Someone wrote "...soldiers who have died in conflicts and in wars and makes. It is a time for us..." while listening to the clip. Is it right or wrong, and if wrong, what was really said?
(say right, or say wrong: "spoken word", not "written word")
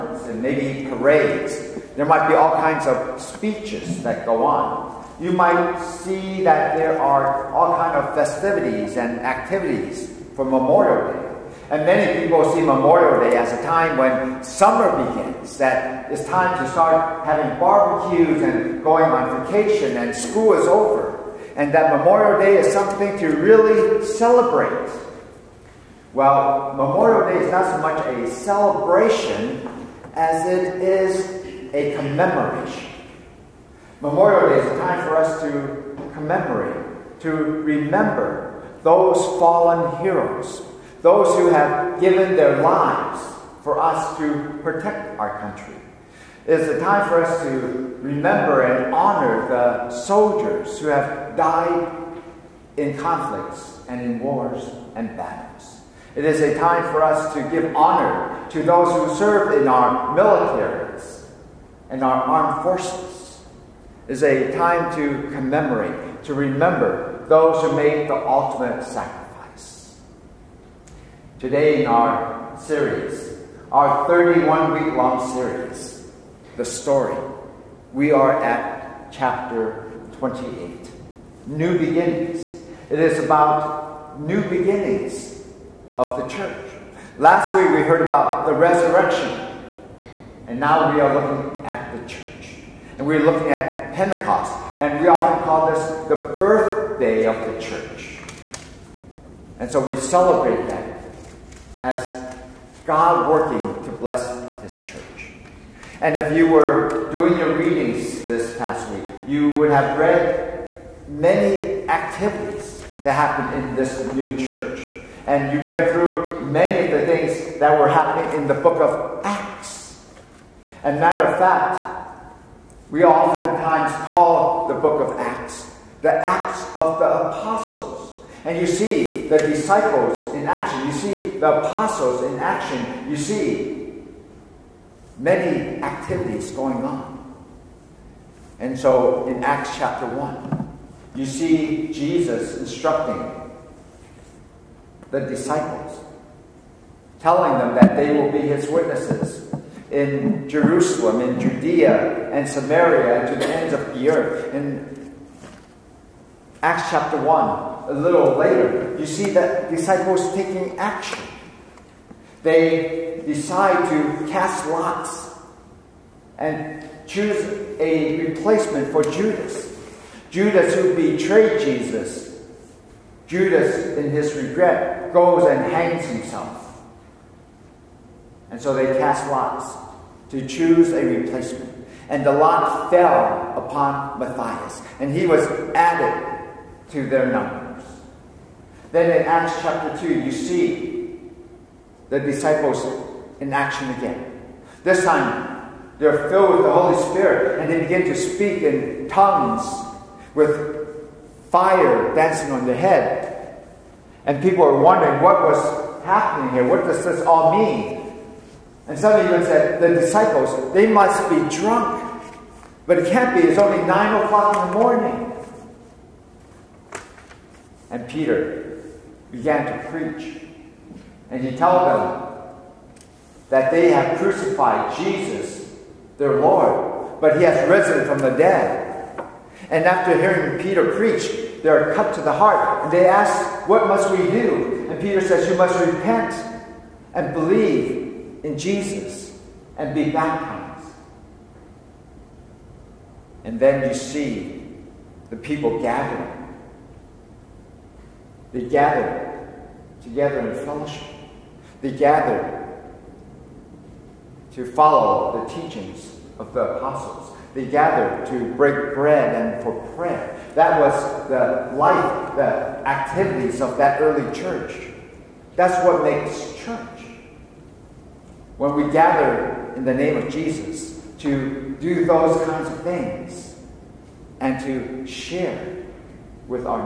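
wrong: "battles", not "makes".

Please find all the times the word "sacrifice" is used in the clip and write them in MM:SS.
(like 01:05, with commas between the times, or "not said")
01:08.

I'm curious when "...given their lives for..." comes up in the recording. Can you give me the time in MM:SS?
00:42.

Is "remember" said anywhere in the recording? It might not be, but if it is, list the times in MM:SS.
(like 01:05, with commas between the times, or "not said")
00:37, 00:48, 01:06.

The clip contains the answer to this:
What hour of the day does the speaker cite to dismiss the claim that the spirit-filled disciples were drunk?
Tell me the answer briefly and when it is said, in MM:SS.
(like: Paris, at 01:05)
9 o'clock in the morning, at 03:33.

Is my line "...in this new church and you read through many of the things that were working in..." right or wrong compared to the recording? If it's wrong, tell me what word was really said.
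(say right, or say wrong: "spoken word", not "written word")
wrong: "happening", not "working".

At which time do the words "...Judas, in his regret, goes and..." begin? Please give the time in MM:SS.
02:53.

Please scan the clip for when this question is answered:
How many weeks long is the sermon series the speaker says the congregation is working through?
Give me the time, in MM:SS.
01:14.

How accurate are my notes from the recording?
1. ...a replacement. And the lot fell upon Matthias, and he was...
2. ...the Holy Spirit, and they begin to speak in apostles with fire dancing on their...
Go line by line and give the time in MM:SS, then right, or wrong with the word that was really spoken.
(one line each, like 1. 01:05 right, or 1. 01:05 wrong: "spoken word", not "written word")
1. 03:00 right
2. 03:16 wrong: "tongues", not "apostles".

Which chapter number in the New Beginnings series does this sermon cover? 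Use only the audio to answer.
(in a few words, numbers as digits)
28.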